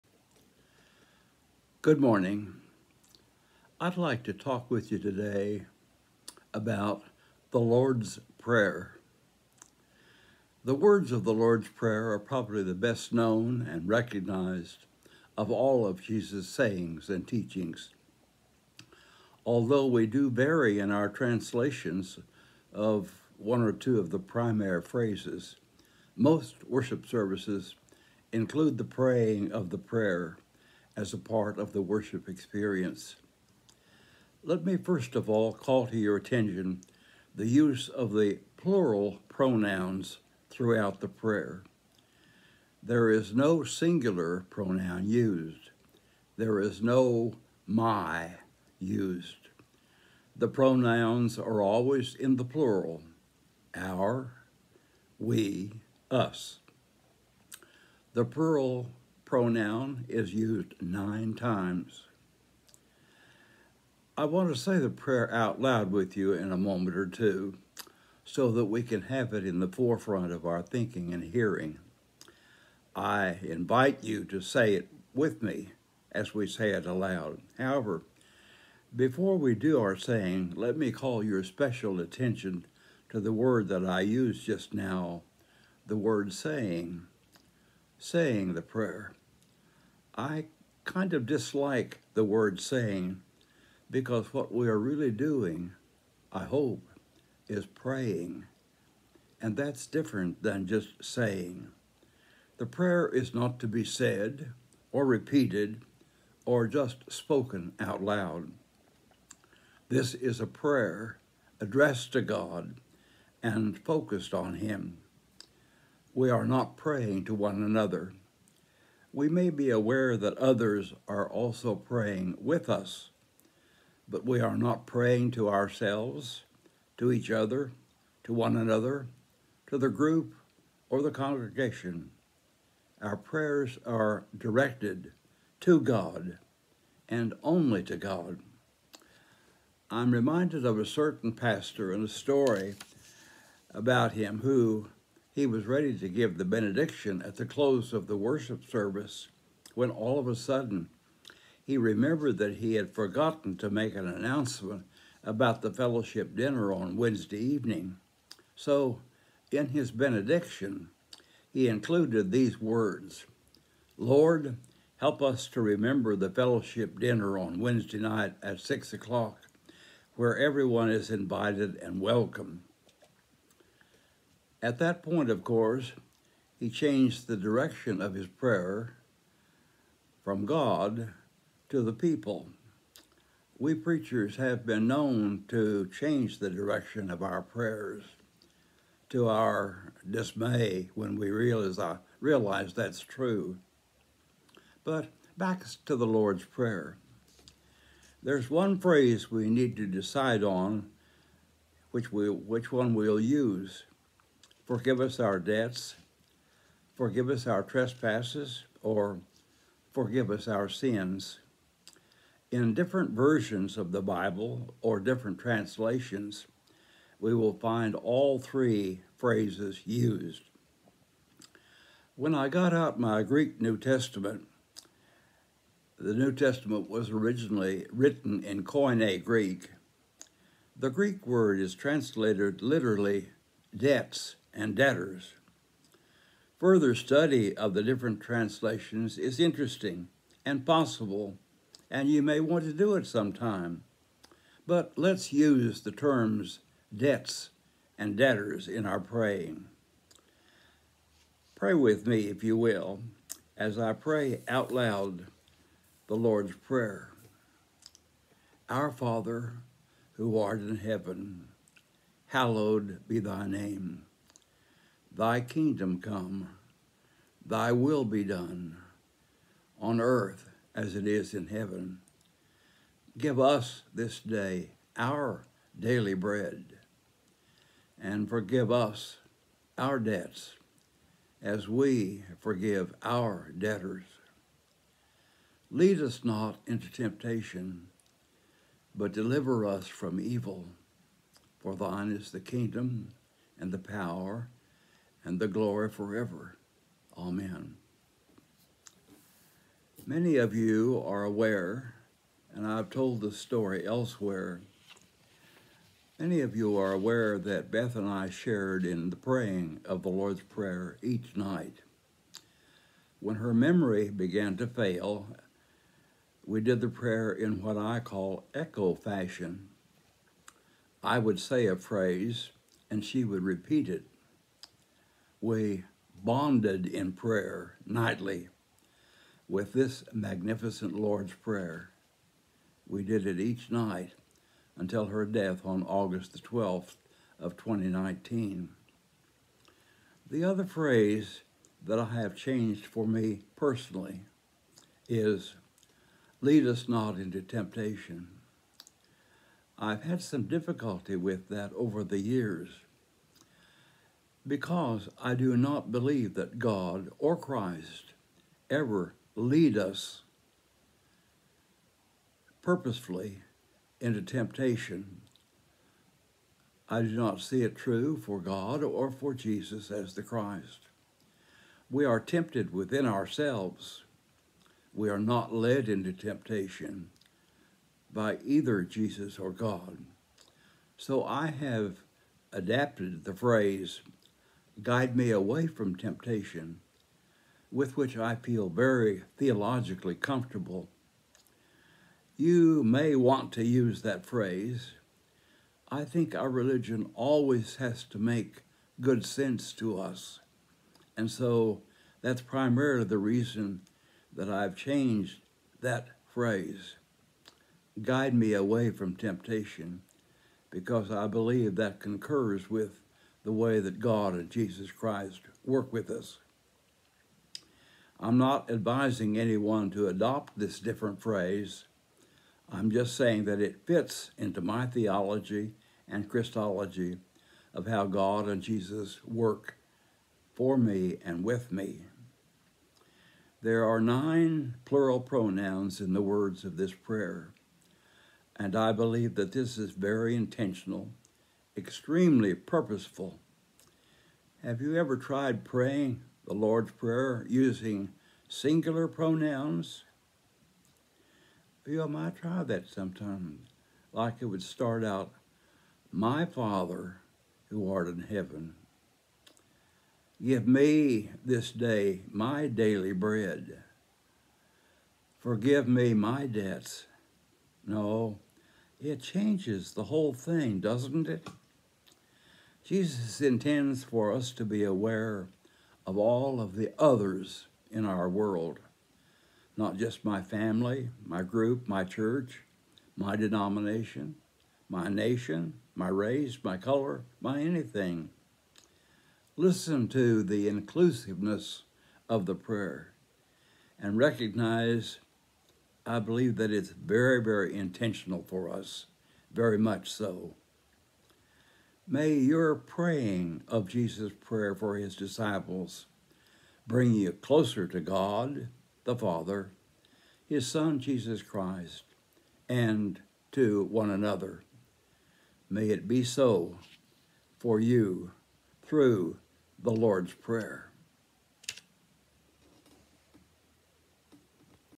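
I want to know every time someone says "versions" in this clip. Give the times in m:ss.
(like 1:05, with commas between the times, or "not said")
3:33.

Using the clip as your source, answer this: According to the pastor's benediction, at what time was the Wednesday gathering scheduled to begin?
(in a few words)
6 o'clock.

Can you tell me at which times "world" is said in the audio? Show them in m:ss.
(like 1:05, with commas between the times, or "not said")
7:58.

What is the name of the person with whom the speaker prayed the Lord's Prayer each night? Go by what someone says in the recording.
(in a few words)
Beth.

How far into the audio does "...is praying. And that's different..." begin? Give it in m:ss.
1:37.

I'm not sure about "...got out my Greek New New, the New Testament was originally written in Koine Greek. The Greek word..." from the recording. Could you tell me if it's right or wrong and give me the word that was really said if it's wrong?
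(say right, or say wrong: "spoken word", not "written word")
wrong: "Testament", not "New".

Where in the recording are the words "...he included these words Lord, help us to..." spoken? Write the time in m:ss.
2:41.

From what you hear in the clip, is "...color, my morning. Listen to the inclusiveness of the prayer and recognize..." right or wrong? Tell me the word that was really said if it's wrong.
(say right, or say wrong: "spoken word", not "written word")
wrong: "anything", not "morning".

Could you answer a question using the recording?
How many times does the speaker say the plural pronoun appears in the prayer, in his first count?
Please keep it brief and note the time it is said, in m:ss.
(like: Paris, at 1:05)
9, at 1:00.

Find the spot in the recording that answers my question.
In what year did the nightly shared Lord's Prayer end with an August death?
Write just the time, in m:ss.
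5:37.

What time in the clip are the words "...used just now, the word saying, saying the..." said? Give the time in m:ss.
1:24.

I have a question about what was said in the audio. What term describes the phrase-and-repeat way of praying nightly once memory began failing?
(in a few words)
Echo fashion.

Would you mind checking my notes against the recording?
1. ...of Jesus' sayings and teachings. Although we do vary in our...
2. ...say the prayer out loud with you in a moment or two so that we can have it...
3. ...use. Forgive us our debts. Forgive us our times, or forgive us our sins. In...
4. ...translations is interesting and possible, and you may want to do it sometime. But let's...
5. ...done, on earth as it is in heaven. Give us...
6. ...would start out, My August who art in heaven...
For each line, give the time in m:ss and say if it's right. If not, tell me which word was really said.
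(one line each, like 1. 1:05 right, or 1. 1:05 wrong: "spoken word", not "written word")
1. 0:15 right
2. 1:04 right
3. 3:23 wrong: "trespasses", not "times"
4. 3:58 right
5. 4:28 right
6. 7:34 wrong: "Father", not "August".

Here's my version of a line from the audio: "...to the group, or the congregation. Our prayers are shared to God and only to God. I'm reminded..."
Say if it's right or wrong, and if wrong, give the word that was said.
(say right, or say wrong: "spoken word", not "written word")
wrong: "directed", not "shared".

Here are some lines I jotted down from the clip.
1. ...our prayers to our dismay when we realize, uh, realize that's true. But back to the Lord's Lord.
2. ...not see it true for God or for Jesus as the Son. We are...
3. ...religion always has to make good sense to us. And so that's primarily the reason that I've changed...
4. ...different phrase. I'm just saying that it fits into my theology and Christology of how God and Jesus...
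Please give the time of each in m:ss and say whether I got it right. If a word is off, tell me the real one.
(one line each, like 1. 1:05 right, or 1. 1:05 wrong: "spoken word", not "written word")
1. 3:07 wrong: "Prayer", not "Lord"
2. 6:07 wrong: "Christ", not "Son"
3. 6:36 right
4. 7:00 right.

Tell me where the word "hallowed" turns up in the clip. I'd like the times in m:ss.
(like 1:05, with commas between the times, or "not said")
4:22.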